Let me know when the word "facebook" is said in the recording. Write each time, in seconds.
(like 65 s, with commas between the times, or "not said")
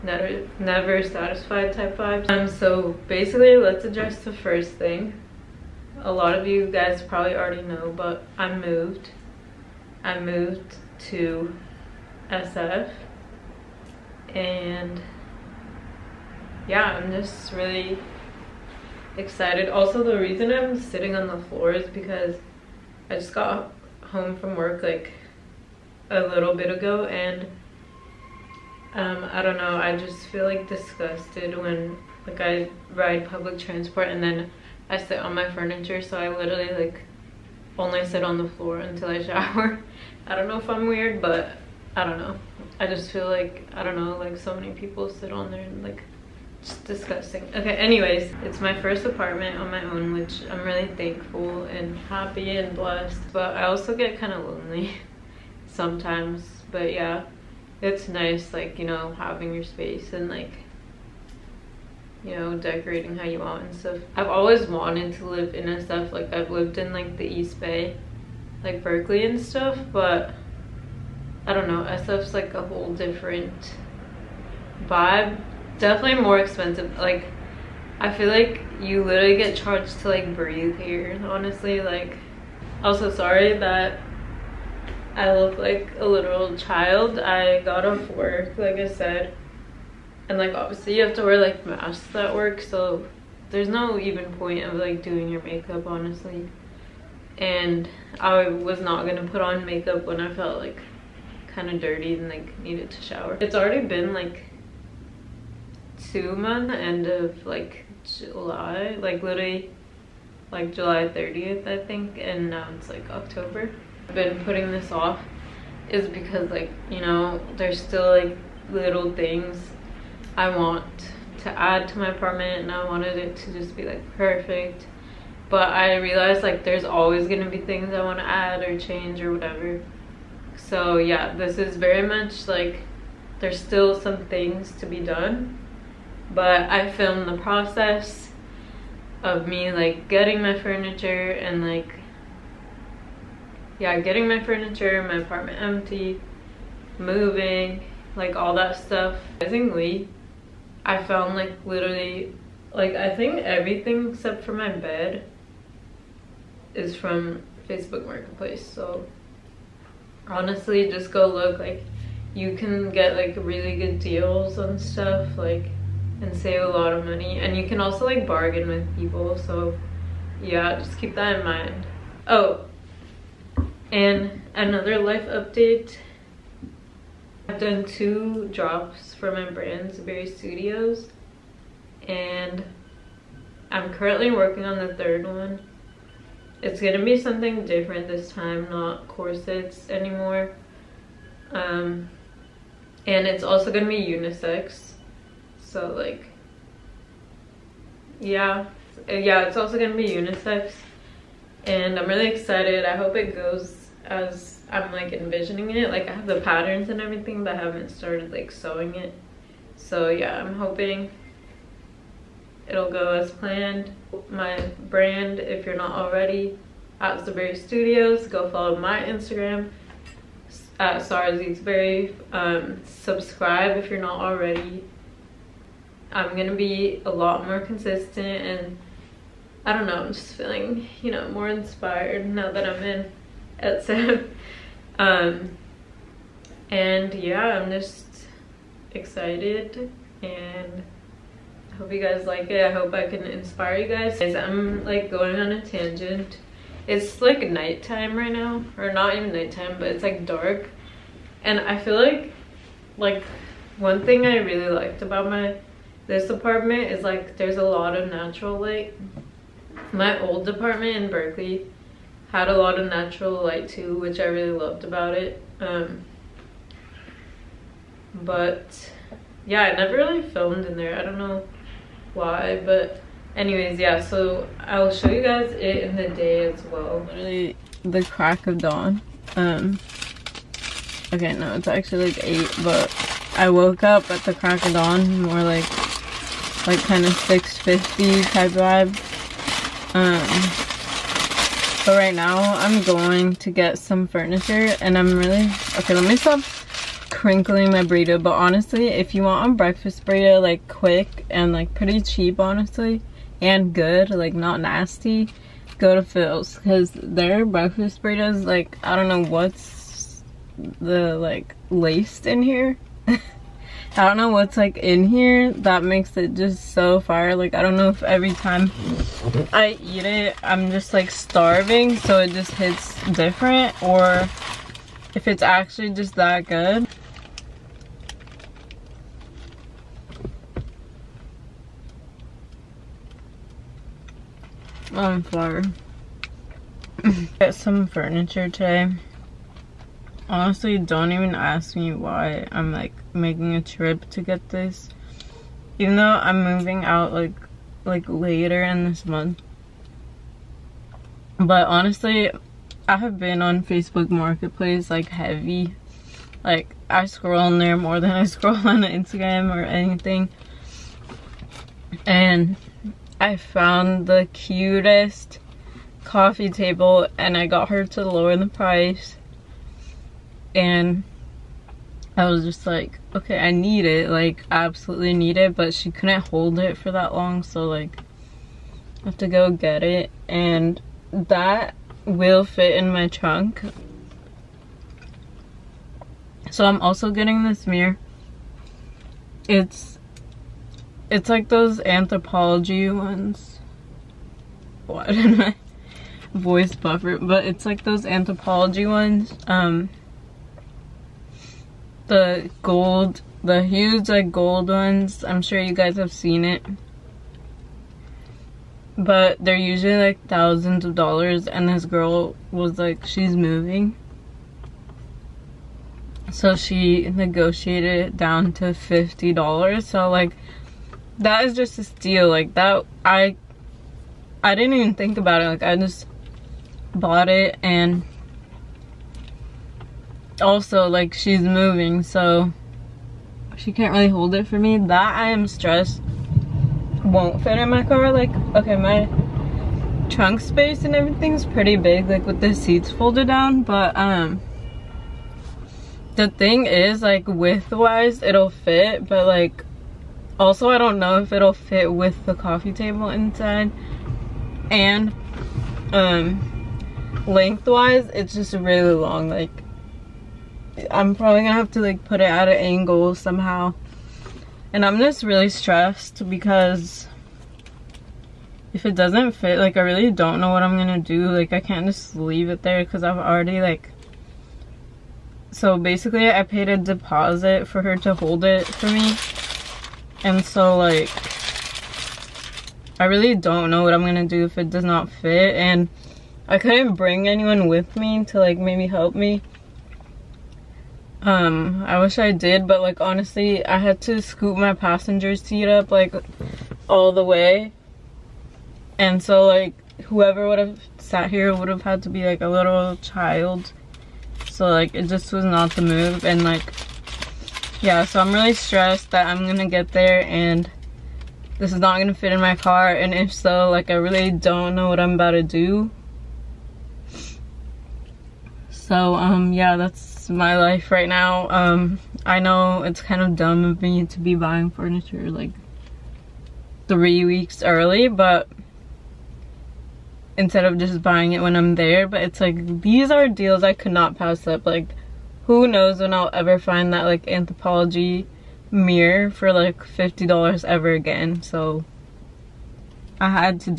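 157 s, 353 s.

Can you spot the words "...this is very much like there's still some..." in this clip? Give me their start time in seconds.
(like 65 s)
131 s.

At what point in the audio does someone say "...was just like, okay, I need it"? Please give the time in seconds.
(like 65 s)
372 s.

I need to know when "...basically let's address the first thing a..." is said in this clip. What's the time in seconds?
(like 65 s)
3 s.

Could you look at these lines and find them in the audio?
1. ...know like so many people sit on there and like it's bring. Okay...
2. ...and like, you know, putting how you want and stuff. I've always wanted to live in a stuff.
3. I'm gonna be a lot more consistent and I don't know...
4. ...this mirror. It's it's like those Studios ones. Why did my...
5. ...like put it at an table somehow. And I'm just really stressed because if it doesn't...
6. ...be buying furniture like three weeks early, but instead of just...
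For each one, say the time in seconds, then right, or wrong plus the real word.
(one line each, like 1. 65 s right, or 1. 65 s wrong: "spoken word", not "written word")
1. 43 s wrong: "disgusting", not "bring"
2. 60 s wrong: "decorating", not "putting"
3. 226 s right
4. 387 s wrong: "Anthropologie", not "Studios"
5. 461 s wrong: "angle", not "table"
6. 524 s right.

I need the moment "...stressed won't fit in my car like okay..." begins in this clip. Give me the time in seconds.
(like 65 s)
435 s.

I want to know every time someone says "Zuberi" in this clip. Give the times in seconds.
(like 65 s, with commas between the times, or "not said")
179 s, 217 s.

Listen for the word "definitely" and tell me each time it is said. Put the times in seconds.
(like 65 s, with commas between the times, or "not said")
75 s.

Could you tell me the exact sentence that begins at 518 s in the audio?
So um yeah, that's my life right now.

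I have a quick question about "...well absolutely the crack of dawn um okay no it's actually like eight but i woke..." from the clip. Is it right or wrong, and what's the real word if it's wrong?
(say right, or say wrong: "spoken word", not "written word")
wrong: "literally", not "absolutely".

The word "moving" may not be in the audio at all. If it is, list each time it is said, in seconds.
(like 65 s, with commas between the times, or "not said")
146 s, 346 s, 413 s, 431 s.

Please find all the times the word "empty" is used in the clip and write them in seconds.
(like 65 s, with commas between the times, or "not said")
145 s.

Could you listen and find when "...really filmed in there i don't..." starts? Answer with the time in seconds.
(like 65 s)
269 s.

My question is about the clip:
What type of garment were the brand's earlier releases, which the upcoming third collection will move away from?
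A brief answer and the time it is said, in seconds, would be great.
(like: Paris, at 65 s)
Corsets, at 189 s.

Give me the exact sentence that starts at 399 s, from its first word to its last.
Um, the gold, the huge like gold ones.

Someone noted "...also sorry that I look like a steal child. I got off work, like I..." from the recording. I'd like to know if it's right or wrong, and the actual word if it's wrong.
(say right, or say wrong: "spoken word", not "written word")
wrong: "literal", not "steal".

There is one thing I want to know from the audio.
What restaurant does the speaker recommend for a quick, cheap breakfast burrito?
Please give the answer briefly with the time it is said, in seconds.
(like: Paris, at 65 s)
Phil's, at 306 s.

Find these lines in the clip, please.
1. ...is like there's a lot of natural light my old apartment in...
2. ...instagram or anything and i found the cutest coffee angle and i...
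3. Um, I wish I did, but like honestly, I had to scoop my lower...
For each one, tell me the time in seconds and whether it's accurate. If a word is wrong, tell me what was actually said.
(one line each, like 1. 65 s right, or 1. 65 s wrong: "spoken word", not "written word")
1. 256 s right
2. 358 s wrong: "table", not "angle"
3. 491 s wrong: "passenger", not "lower".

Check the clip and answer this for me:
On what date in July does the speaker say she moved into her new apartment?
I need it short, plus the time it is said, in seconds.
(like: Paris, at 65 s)
July 30th, at 110 s.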